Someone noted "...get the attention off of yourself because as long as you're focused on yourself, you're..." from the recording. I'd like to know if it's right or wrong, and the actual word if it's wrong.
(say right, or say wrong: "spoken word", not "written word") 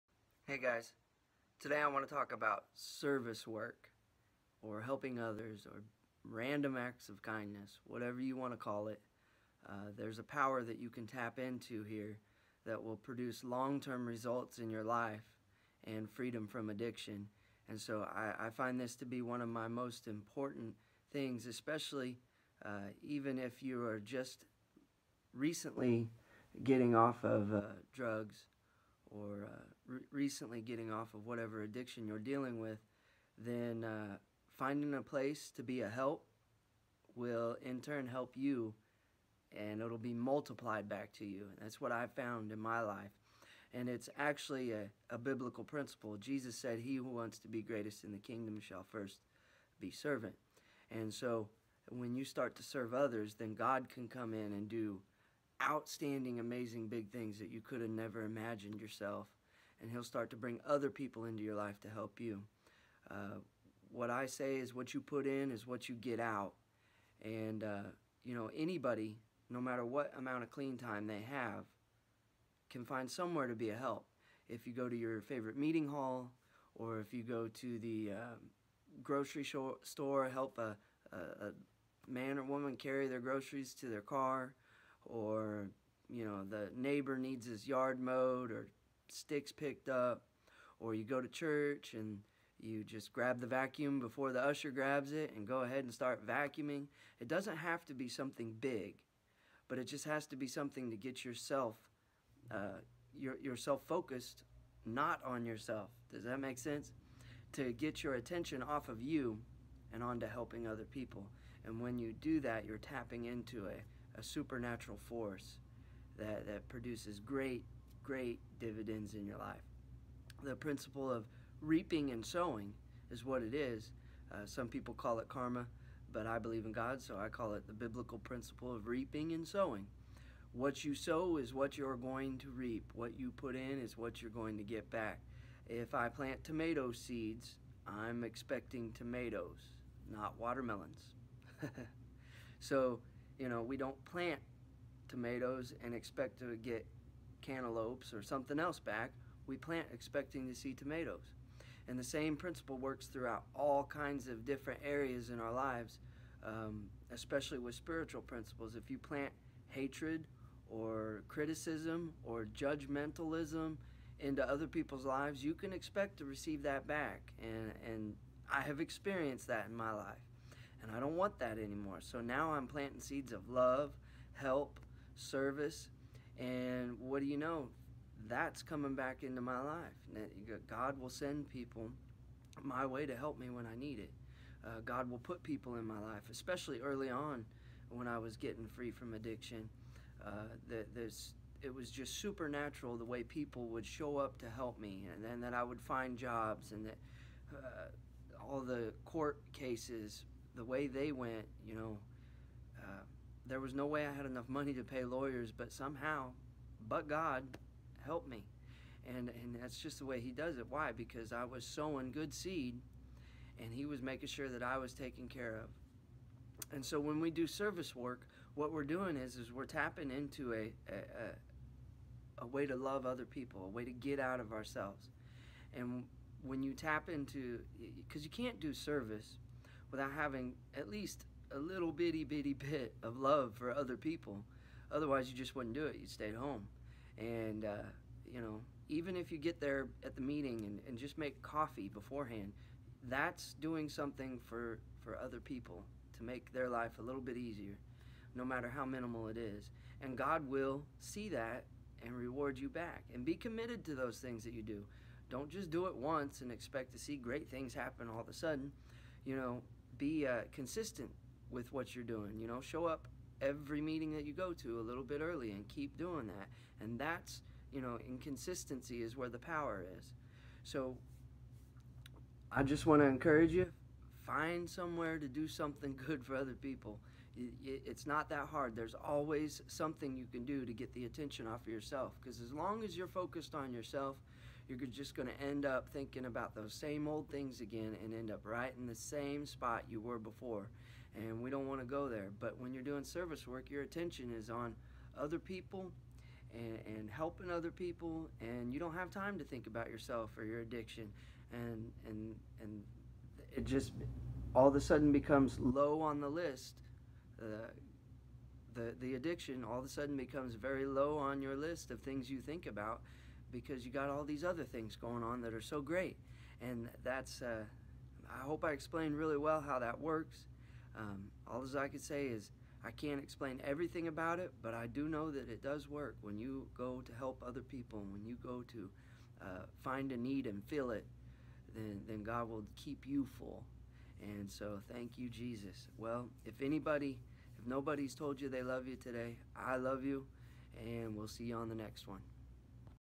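right.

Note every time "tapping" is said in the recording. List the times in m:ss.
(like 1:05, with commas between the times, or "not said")
1:52, 3:39.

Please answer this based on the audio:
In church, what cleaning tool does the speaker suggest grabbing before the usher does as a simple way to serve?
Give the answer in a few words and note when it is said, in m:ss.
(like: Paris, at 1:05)
The vacuum, at 1:33.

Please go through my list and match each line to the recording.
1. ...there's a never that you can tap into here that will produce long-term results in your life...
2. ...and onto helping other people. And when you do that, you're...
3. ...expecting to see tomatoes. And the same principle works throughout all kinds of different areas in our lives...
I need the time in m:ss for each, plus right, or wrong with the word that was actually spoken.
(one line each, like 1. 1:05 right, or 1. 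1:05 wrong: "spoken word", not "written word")
1. 0:09 wrong: "power", not "never"
2. 1:49 right
3. 2:29 right.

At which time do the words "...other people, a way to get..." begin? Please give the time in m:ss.
3:43.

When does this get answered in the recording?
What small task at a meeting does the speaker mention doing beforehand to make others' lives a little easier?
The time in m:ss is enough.
4:01.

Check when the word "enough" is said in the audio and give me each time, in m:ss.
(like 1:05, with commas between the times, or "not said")
3:24.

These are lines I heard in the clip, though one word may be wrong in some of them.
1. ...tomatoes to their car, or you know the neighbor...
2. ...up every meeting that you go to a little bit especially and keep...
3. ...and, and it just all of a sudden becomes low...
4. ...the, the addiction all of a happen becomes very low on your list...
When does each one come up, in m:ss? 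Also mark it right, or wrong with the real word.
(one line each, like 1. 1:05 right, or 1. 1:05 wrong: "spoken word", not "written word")
1. 1:23 wrong: "groceries", not "tomatoes"
2. 4:22 wrong: "early", not "especially"
3. 5:02 right
4. 5:08 wrong: "sudden", not "happen".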